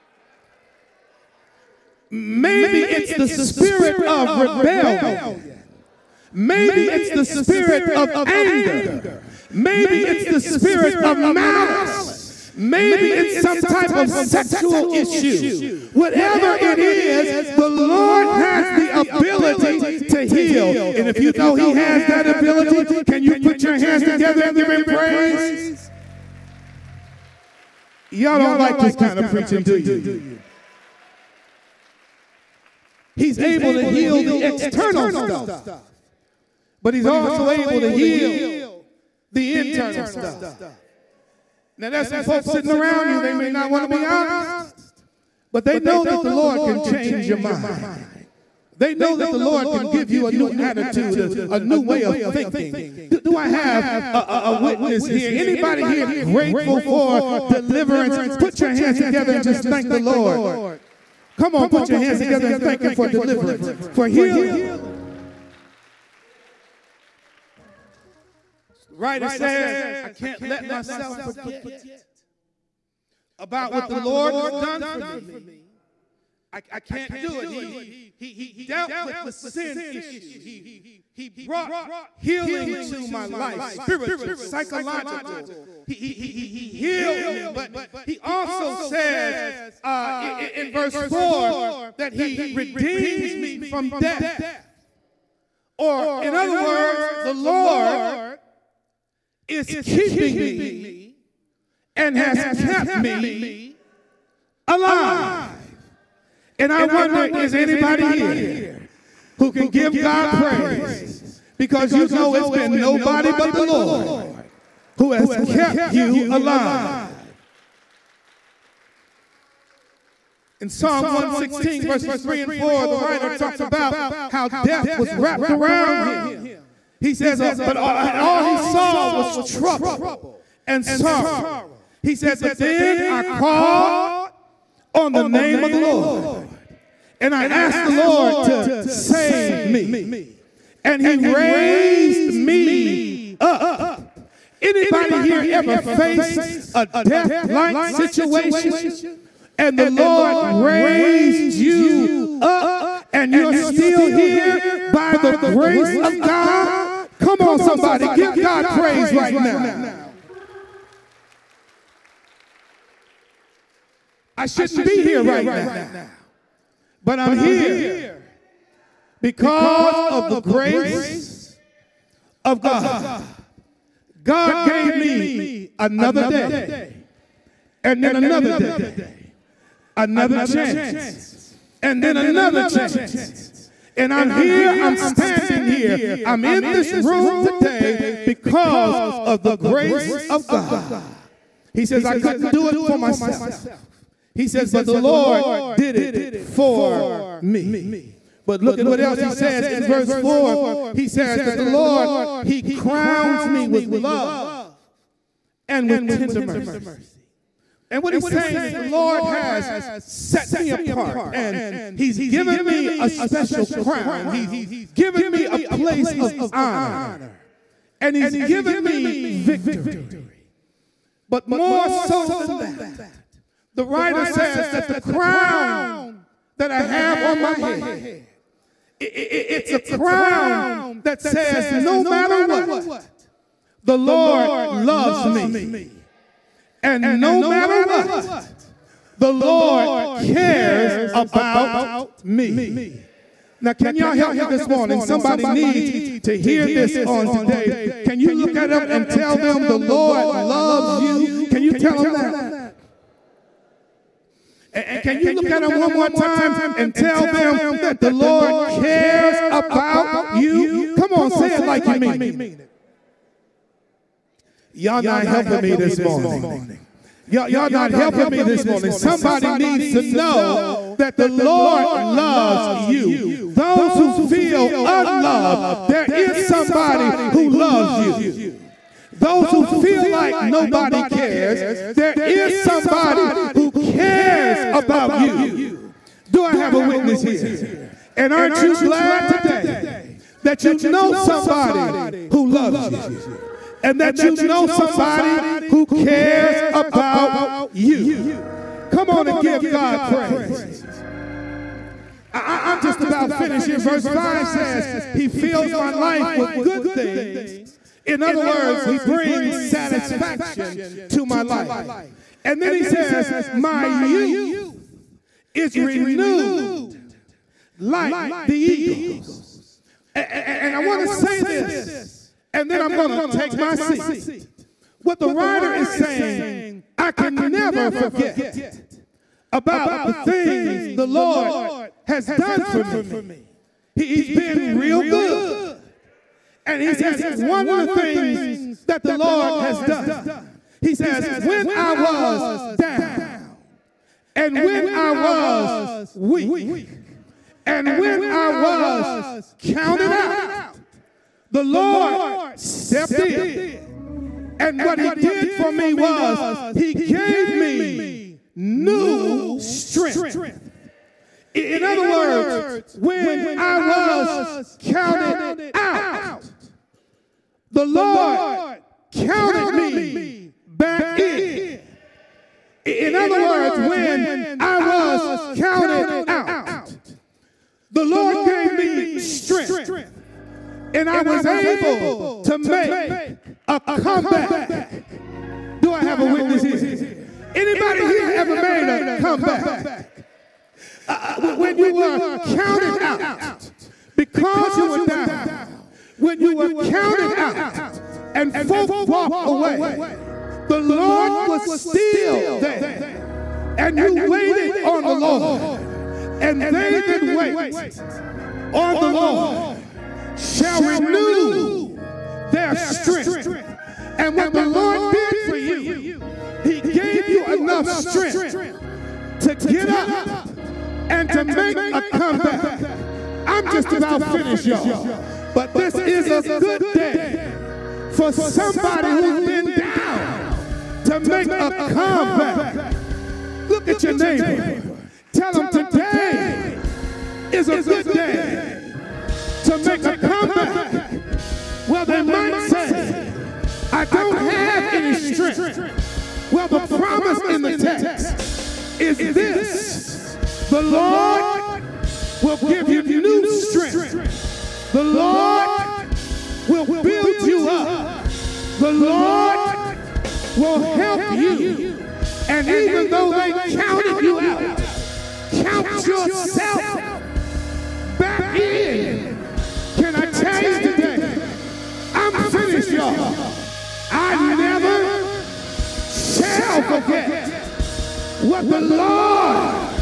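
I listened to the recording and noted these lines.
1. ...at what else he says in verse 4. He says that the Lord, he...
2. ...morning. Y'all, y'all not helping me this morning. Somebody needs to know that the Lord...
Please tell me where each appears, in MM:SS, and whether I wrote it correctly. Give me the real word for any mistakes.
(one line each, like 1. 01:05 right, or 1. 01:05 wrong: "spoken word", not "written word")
1. 03:18 right
2. 04:25 right.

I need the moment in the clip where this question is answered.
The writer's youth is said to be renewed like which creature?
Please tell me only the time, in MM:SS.
05:18.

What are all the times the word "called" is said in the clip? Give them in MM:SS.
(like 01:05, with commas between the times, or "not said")
02:13.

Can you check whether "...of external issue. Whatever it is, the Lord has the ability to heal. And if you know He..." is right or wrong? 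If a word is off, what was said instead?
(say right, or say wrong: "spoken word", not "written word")
wrong: "sexual", not "external".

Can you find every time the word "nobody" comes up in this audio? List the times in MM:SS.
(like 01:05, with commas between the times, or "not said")
01:52, 04:40.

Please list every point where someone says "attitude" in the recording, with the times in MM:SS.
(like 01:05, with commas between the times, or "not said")
00:50.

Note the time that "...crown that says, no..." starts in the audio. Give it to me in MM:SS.
03:49.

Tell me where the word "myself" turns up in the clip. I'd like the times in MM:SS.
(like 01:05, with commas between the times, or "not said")
01:10, 03:12.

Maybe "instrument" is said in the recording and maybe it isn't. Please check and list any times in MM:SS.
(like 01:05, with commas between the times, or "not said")
not said.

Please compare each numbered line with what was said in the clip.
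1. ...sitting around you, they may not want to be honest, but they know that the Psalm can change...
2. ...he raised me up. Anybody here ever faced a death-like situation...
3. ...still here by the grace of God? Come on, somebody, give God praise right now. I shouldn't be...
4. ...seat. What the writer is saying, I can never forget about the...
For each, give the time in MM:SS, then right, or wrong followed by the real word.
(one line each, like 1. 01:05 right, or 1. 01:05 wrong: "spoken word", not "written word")
1. 00:42 wrong: "Lord", not "Psalm"
2. 02:21 right
3. 02:33 right
4. 05:23 right.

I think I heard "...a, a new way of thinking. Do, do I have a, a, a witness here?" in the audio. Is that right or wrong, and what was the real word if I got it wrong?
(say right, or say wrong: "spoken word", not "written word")
right.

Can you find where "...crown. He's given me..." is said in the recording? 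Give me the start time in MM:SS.
03:33.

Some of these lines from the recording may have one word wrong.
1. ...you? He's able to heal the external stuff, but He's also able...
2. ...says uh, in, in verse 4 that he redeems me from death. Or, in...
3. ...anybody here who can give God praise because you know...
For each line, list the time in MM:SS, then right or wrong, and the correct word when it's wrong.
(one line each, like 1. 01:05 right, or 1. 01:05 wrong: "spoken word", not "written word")
1. 00:29 right
2. 01:28 right
3. 01:47 right.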